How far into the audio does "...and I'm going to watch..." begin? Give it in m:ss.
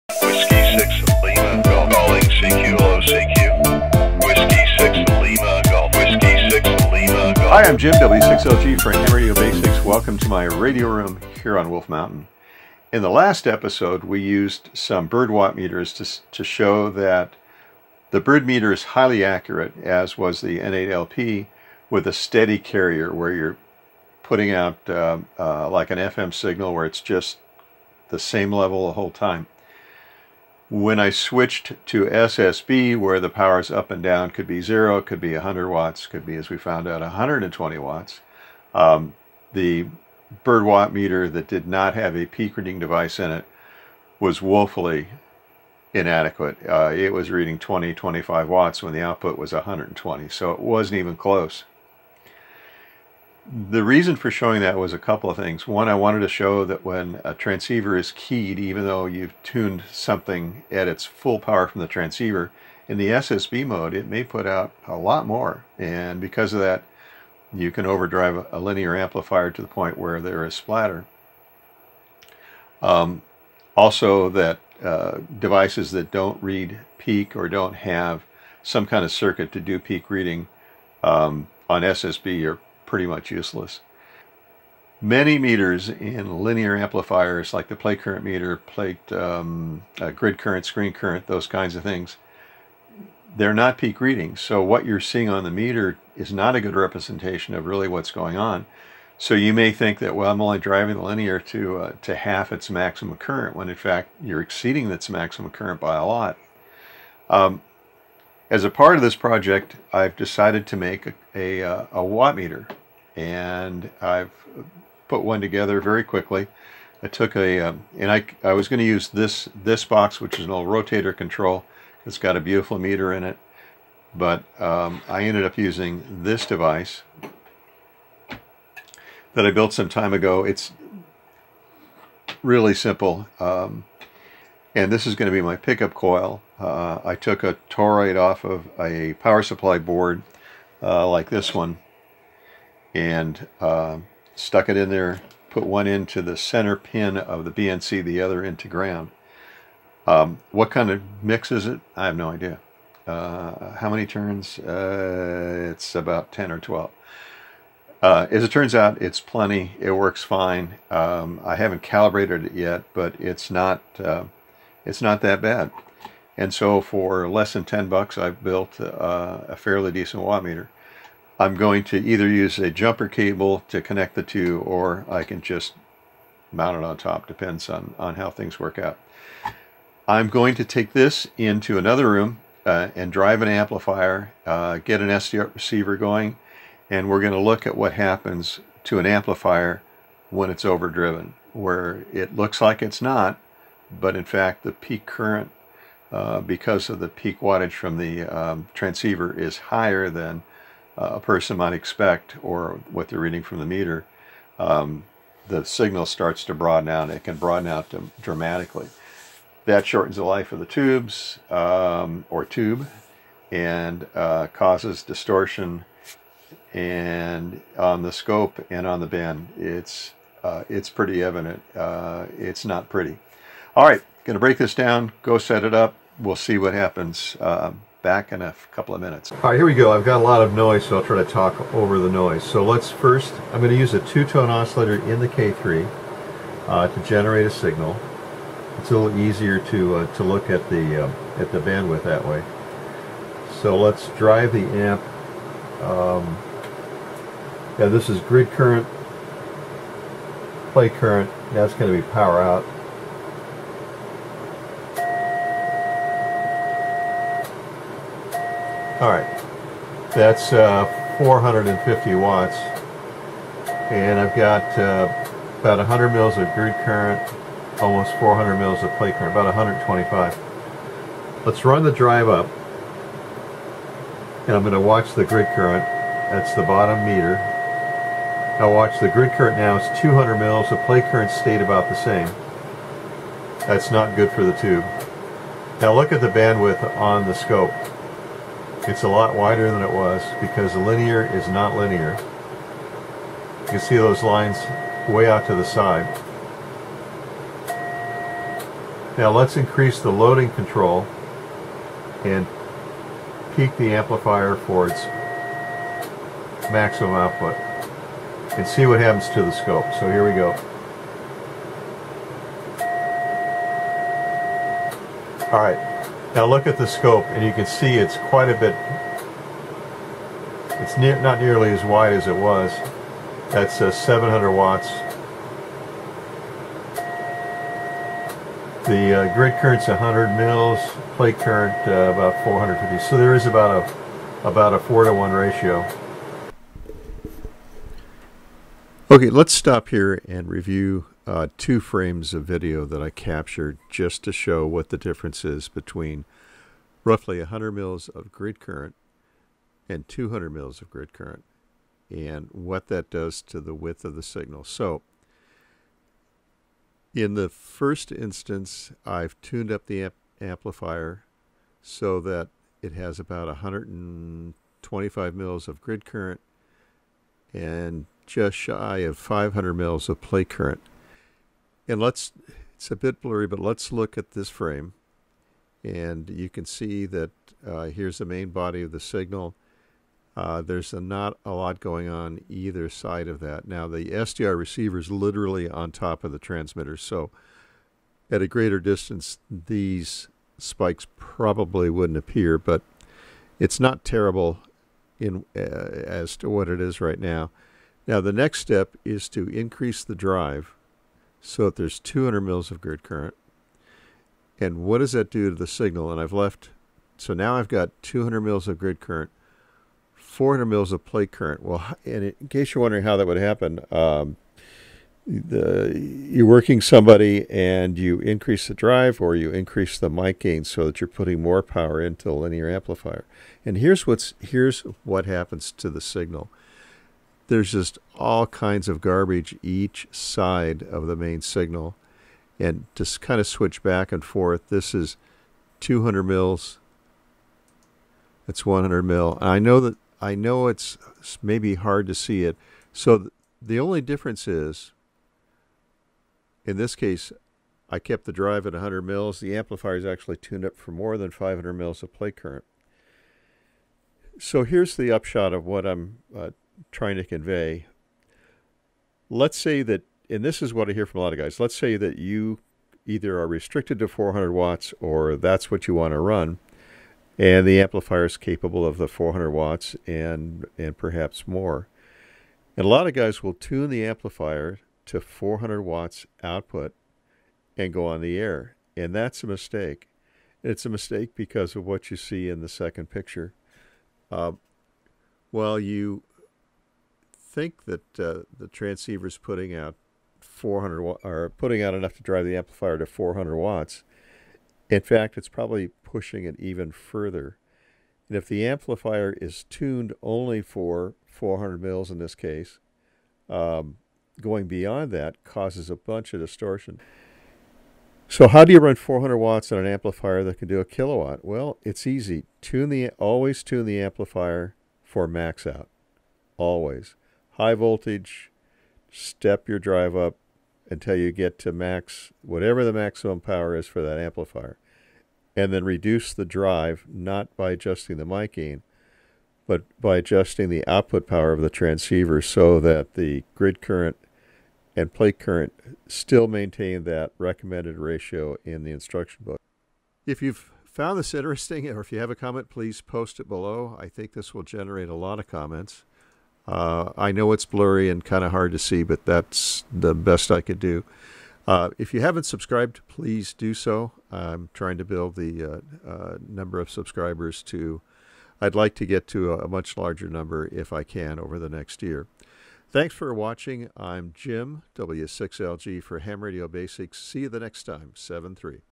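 4:34.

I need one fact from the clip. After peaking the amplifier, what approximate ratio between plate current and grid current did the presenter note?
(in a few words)
4 to 1.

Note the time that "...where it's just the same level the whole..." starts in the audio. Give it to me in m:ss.
0:26.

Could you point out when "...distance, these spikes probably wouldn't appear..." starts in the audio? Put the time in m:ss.
6:28.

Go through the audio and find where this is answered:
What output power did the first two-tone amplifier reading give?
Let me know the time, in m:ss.
4:21.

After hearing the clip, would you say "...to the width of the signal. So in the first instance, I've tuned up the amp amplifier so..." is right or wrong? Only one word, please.
right.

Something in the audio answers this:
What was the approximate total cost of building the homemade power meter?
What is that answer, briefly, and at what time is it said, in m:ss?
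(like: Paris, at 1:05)
less than 10 bucks, at 2:47.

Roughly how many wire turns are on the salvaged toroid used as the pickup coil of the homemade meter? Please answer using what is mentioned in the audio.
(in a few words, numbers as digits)
10 or 12.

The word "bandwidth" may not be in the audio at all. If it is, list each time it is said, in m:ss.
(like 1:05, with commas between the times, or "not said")
4:01, 4:46.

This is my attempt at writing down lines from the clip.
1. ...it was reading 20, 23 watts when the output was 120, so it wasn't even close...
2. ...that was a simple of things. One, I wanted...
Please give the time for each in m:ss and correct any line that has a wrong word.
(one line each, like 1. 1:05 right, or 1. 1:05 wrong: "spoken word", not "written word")
1. 0:46 wrong: "25", not "23"
2. 0:54 wrong: "couple", not "simple".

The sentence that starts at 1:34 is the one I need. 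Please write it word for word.
So what you're seeing on the meter is not a good representation of really what's going on.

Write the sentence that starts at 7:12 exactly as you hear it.
And just kind of switch back and forth.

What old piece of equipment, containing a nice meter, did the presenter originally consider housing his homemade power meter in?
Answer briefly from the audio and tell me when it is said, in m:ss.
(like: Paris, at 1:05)
rotator control, at 2:00.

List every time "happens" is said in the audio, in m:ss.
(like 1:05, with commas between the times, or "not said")
3:07, 3:46, 5:08, 6:53, 7:05.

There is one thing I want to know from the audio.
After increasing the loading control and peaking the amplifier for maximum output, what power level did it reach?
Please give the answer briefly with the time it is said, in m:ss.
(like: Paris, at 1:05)
700 watts, at 5:23.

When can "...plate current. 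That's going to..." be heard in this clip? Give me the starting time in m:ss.
4:10.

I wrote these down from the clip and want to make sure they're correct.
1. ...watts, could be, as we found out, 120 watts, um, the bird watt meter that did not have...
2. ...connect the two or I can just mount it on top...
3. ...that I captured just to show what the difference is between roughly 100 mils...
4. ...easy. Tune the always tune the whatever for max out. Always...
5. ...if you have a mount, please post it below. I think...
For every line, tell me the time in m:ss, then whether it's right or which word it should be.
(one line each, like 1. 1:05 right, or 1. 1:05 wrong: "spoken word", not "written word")
1. 0:35 right
2. 2:53 right
3. 5:42 right
4. 8:32 wrong: "amplifier", not "whatever"
5. 9:02 wrong: "comment", not "mount".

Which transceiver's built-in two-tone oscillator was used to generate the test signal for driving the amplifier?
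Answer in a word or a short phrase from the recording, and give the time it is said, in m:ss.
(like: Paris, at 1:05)
K3, at 3:55.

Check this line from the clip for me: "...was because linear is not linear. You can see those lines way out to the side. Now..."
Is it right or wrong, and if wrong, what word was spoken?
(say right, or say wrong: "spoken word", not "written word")
right.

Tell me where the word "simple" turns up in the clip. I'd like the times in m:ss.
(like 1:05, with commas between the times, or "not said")
2:12.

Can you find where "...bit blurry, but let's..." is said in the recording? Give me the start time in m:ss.
6:12.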